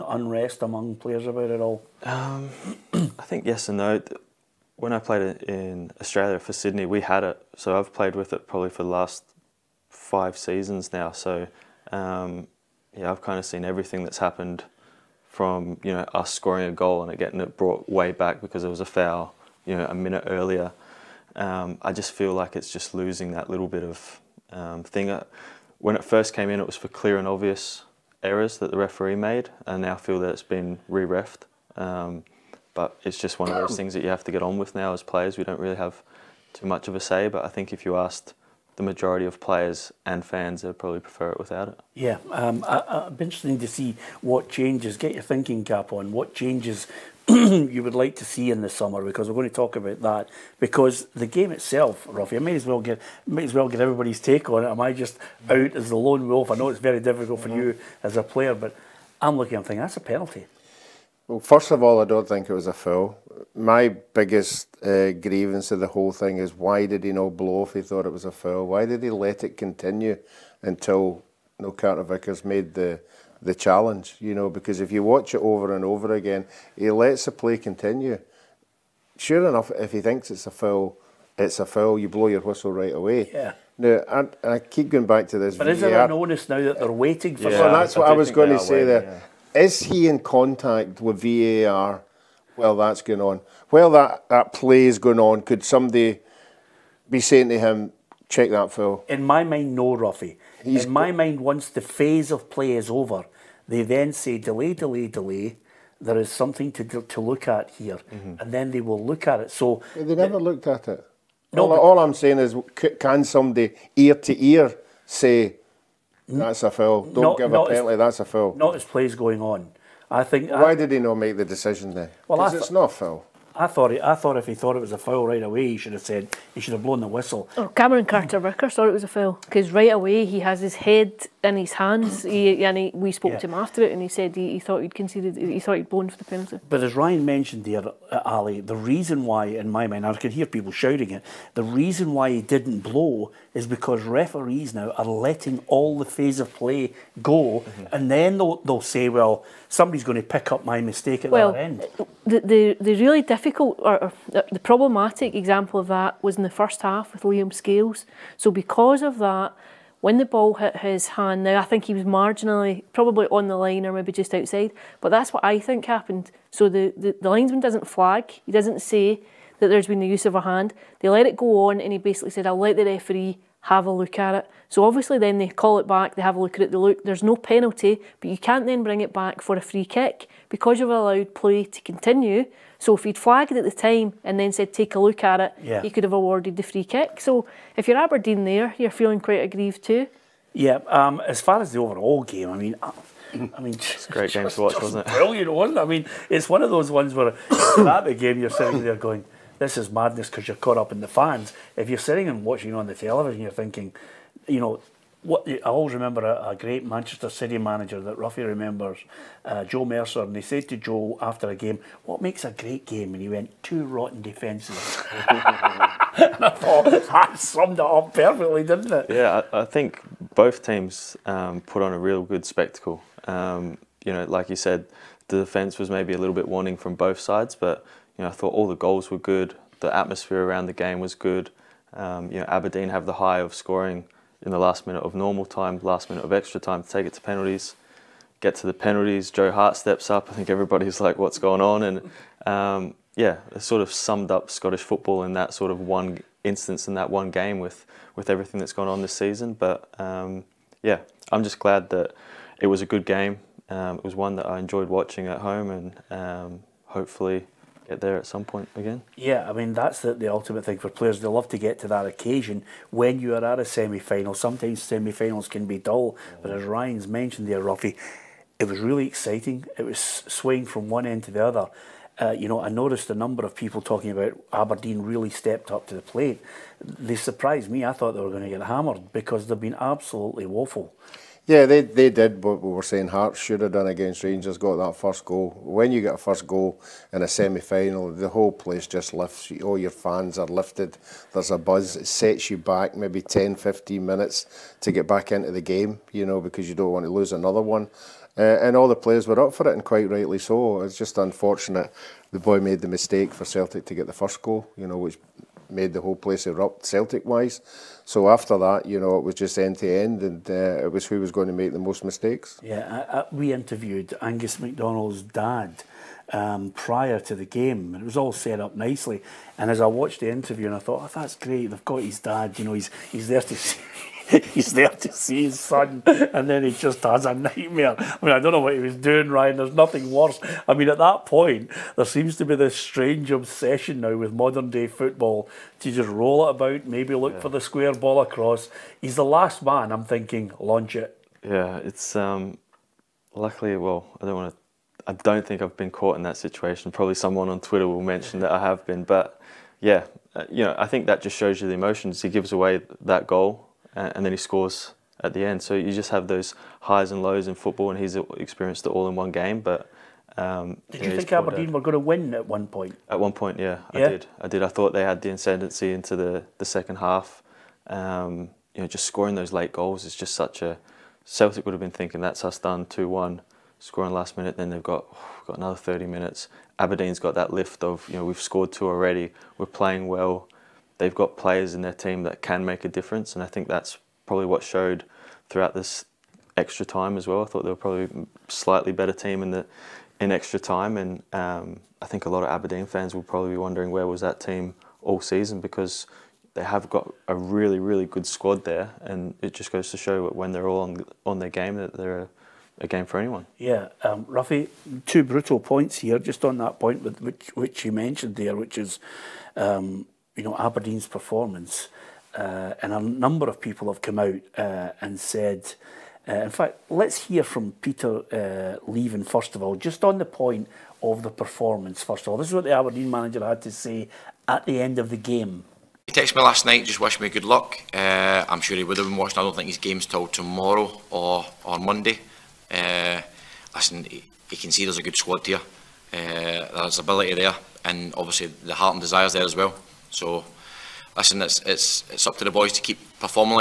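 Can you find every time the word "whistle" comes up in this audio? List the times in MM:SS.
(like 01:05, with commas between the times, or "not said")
01:22, 02:07.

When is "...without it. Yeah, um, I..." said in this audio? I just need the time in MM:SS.
00:41.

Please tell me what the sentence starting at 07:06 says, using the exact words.
He texted me last night, just wished me good luck.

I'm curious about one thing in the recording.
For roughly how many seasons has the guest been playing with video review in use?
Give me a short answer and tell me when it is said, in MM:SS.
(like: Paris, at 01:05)
5, at 00:09.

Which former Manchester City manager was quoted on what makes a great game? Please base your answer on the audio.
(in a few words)
Joe Mercer.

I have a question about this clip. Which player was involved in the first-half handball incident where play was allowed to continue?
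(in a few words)
Liam Scales.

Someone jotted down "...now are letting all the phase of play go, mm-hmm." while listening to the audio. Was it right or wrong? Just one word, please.
right.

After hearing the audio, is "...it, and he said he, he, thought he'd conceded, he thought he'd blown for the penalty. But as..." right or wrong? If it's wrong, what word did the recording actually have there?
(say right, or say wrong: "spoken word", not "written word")
right.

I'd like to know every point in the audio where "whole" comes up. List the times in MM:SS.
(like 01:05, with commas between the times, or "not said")
01:05, 04:48, 05:06.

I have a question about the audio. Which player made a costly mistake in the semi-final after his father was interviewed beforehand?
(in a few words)
Angus MacDonald.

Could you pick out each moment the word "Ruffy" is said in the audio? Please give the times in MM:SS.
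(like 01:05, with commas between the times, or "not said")
00:52, 01:39, 03:28, 04:27, 06:44.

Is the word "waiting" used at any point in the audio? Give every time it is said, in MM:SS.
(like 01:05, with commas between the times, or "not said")
01:26.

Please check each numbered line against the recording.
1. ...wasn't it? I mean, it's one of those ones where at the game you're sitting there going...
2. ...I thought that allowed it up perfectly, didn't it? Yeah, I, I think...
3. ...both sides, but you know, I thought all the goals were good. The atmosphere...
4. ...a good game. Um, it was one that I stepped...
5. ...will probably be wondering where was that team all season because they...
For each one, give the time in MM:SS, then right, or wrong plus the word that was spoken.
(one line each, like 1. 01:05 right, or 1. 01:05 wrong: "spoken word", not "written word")
1. 03:15 right
2. 03:35 wrong: "summed", not "allowed"
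3. 03:46 right
4. 04:12 wrong: "enjoyed", not "stepped"
5. 06:33 right.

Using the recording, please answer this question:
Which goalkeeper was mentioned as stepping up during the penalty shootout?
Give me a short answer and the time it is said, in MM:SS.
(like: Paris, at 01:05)
Joe Hart, at 03:59.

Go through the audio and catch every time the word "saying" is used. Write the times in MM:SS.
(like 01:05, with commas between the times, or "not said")
01:37, 01:52, 04:42.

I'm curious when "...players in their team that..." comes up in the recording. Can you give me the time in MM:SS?
06:21.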